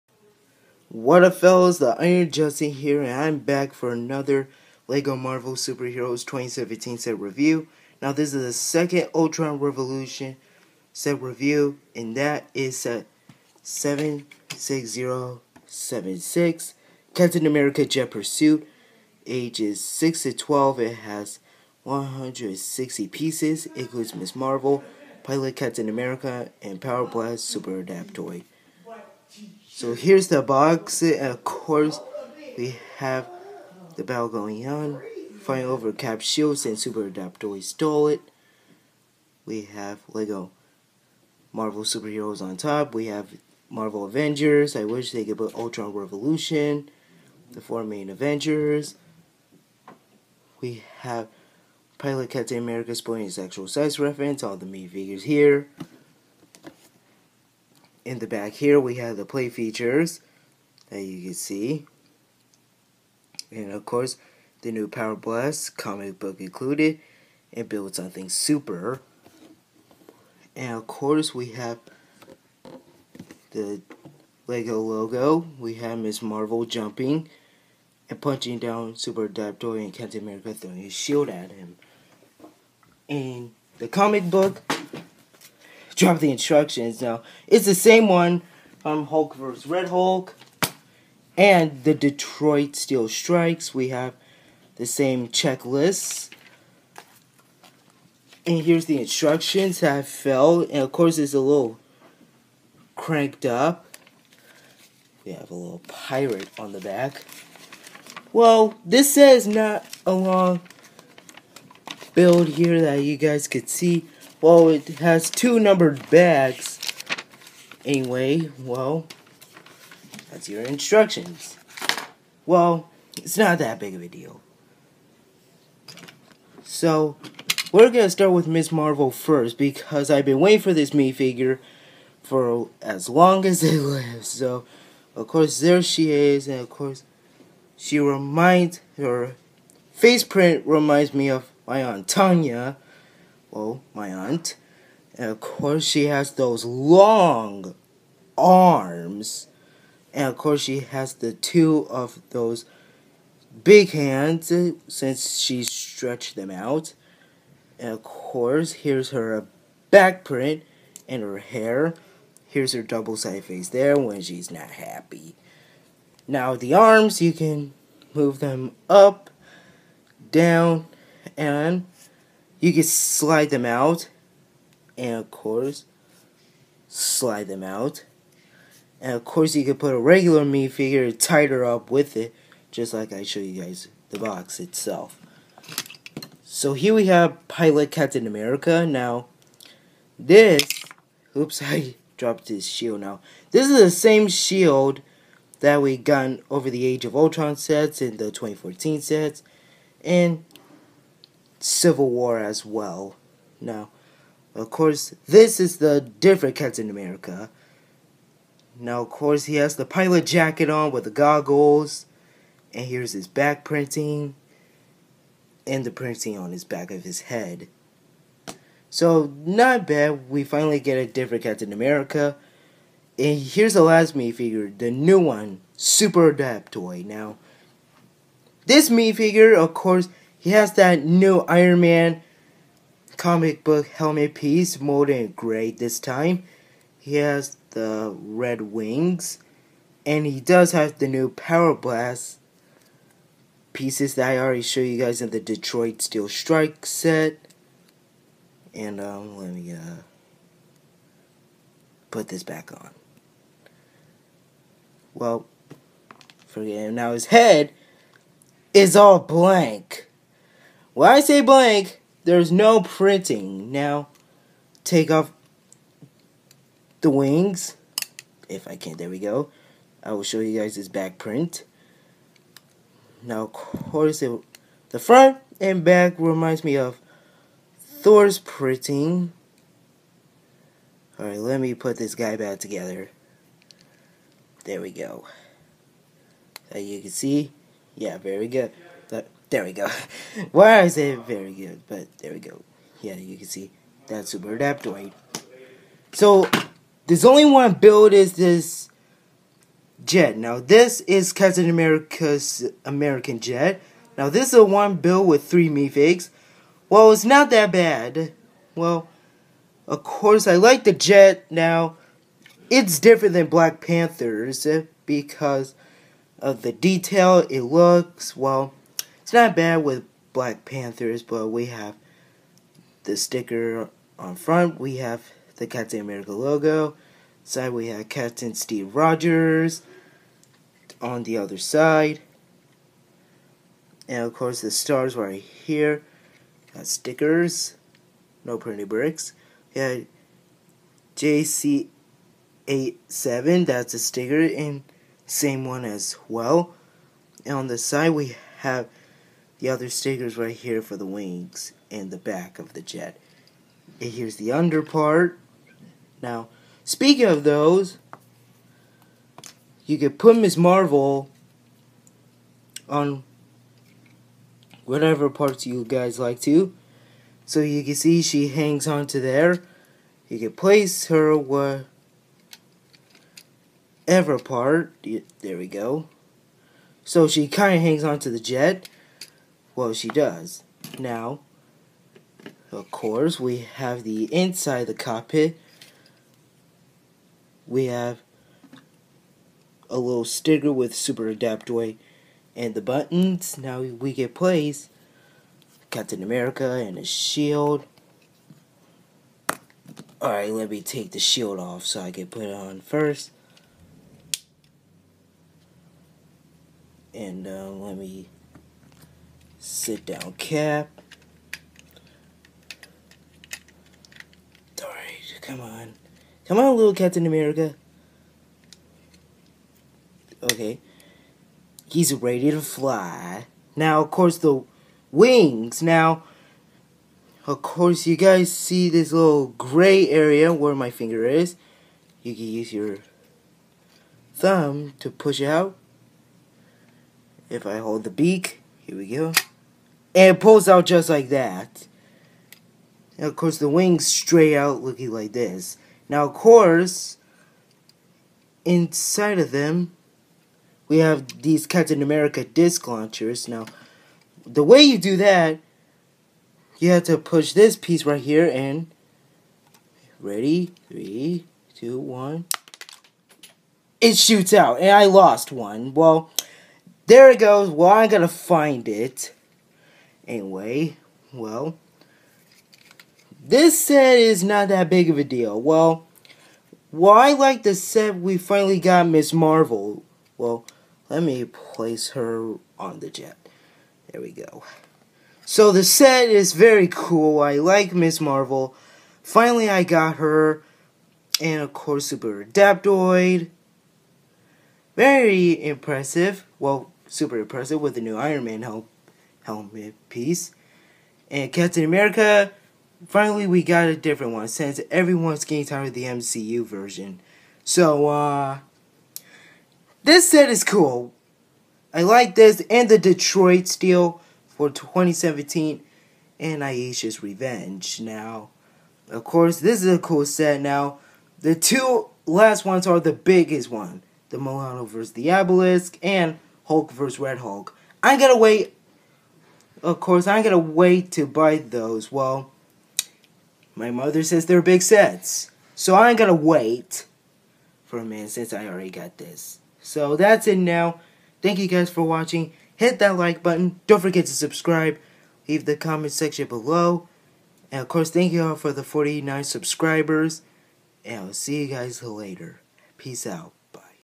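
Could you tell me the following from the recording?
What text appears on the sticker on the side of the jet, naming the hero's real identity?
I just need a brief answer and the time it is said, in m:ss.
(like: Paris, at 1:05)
Captain Steve Rogers, at 5:28.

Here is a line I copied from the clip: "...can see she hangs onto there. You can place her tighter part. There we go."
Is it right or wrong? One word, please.
wrong.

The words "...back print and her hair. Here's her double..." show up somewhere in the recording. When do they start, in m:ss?
2:39.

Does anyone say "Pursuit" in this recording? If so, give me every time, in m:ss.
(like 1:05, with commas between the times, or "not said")
0:18.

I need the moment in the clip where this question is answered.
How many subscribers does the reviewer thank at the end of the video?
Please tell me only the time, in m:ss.
9:08.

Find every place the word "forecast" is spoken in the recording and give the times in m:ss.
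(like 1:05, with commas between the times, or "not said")
not said.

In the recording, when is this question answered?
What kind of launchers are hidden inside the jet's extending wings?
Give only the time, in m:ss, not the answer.
7:32.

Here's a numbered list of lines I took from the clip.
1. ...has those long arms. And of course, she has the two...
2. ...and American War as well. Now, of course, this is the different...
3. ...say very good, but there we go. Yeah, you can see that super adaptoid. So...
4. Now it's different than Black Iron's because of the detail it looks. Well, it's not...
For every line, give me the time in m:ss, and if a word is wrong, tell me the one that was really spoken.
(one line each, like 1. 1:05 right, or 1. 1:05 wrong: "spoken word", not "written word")
1. 2:26 right
2. 3:20 wrong: "Civil", not "American"
3. 4:50 right
4. 5:11 wrong: "Panther", not "Iron".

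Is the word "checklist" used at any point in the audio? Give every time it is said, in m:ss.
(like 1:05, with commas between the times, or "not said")
1:35.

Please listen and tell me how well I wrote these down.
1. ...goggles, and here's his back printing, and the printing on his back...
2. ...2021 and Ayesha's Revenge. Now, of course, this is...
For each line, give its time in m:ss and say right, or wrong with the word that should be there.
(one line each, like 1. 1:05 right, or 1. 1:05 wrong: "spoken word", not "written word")
1. 3:31 right
2. 8:34 wrong: "2017", not "2021".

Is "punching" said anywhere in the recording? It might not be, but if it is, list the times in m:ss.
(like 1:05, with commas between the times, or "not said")
1:18.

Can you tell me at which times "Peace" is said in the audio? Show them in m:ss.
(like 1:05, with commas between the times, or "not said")
9:12.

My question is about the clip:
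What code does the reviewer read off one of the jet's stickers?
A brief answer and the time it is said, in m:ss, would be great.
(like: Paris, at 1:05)
JC87, at 5:41.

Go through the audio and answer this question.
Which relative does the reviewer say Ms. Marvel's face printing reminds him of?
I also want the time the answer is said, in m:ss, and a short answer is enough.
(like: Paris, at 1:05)
Aunt Tanya, at 2:21.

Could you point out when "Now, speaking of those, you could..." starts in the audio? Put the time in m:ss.
5:56.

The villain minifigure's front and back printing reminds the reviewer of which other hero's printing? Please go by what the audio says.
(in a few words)
Thor.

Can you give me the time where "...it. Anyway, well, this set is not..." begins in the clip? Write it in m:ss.
7:48.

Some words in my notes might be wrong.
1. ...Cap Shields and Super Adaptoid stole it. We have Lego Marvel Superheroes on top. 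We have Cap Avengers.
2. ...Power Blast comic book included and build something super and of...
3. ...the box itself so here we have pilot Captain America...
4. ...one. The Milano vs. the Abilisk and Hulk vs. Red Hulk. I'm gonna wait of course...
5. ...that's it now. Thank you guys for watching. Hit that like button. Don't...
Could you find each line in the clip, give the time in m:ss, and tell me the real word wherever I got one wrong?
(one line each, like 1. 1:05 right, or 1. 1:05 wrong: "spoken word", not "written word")
1. 0:35 wrong: "Marvel", not "Cap"
2. 1:04 right
3. 3:04 right
4. 8:43 right
5. 9:00 right.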